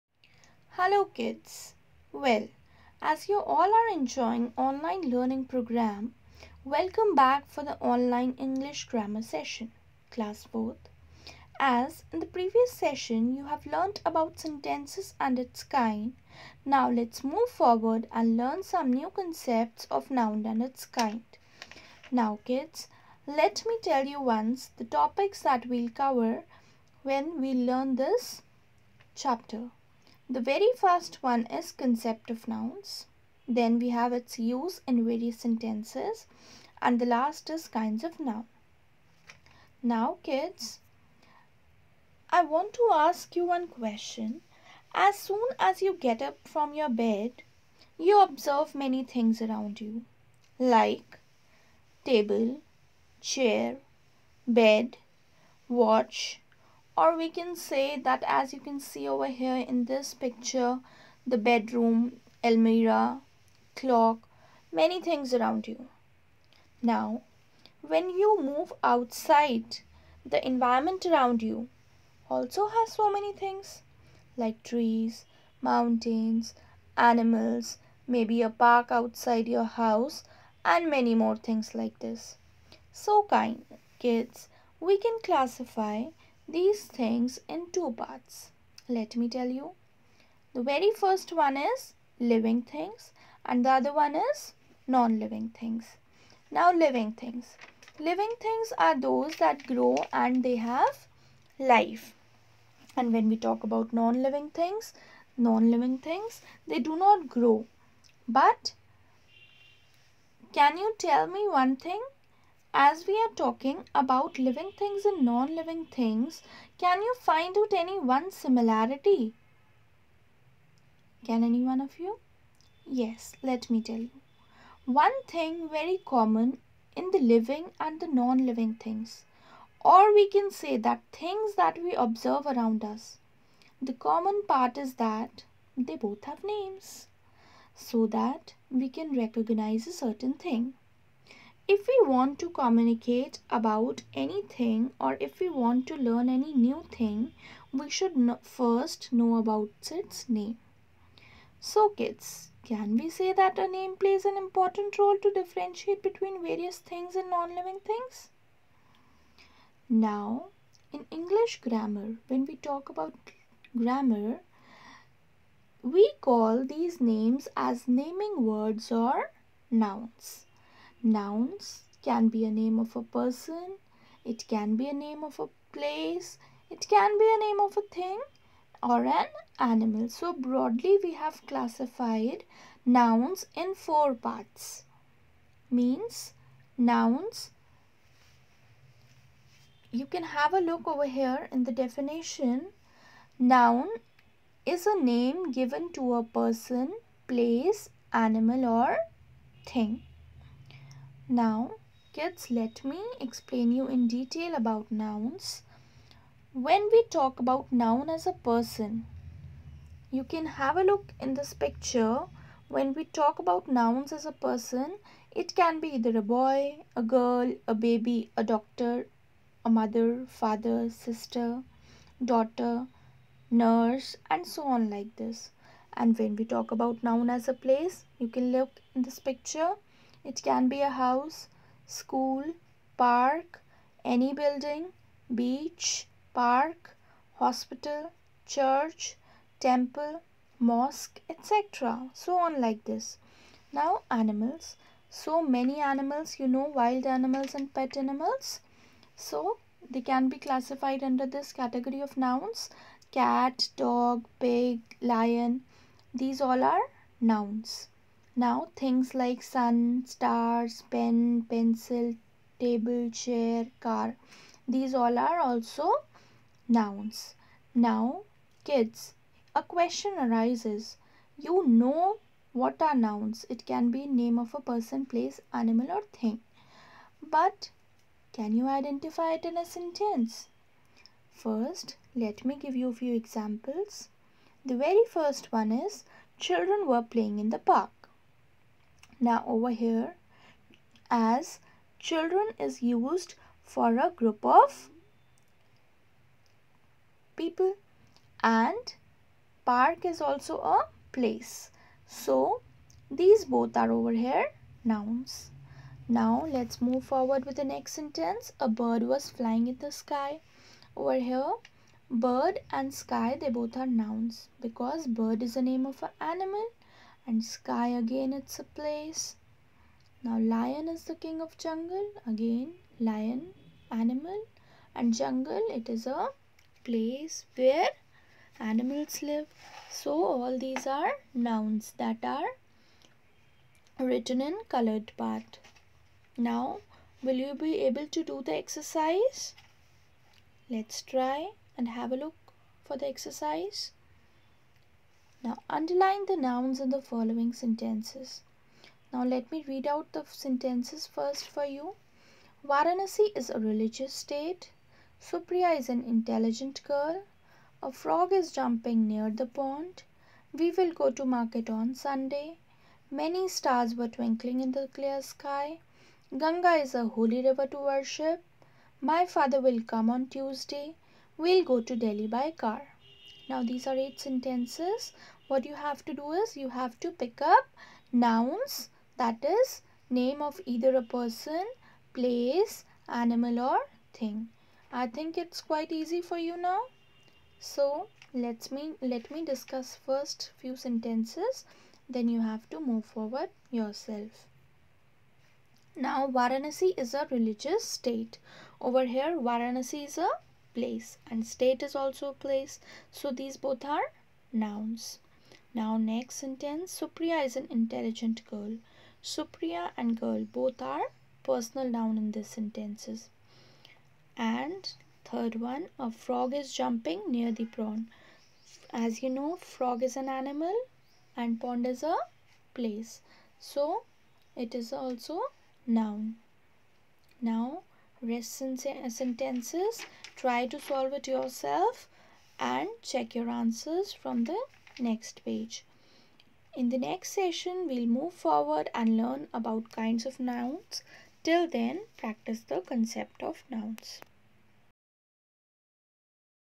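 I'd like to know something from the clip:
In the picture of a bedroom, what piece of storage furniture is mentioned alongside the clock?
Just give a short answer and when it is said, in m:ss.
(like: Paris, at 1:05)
Almirah, at 1:02.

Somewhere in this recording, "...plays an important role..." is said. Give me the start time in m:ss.
2:33.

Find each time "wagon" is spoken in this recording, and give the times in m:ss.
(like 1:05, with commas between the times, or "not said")
not said.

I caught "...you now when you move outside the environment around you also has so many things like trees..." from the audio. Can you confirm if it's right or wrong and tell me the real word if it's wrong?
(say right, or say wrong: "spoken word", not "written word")
right.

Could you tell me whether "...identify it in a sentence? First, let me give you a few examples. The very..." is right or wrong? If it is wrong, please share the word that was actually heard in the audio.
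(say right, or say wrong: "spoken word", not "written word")
right.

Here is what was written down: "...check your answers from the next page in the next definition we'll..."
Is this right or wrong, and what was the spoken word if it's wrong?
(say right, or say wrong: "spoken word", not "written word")
wrong: "session", not "definition".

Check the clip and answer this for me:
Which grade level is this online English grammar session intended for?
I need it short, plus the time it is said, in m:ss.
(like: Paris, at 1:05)
Class 4, at 0:10.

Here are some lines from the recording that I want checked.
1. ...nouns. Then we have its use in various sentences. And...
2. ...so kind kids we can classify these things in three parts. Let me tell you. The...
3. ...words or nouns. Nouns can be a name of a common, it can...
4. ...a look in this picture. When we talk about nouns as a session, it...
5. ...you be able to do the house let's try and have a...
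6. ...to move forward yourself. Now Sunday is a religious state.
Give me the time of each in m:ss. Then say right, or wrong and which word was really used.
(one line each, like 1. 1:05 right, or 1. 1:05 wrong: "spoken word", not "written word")
1. 0:32 right
2. 1:22 wrong: "two", not "three"
3. 2:48 wrong: "person", not "common"
4. 3:30 wrong: "person", not "session"
5. 5:37 wrong: "exercise", not "house"
6. 6:32 wrong: "Varanasi", not "Sunday".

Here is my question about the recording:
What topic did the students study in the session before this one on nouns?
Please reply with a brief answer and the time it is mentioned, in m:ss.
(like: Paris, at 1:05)
Sentences and its kind, at 0:14.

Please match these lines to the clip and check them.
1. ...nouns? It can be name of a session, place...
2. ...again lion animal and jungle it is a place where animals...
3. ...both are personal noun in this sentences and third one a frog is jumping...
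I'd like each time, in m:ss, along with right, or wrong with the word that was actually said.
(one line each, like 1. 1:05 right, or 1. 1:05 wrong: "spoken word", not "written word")
1. 4:32 wrong: "person", not "session"
2. 5:22 right
3. 6:50 right.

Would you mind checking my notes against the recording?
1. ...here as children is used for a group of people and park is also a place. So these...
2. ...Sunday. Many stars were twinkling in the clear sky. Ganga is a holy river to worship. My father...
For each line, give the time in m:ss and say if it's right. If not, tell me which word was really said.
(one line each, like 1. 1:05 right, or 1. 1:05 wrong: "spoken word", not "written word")
1. 4:49 right
2. 6:01 right.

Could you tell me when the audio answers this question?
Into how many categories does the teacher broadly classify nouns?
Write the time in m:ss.
3:03.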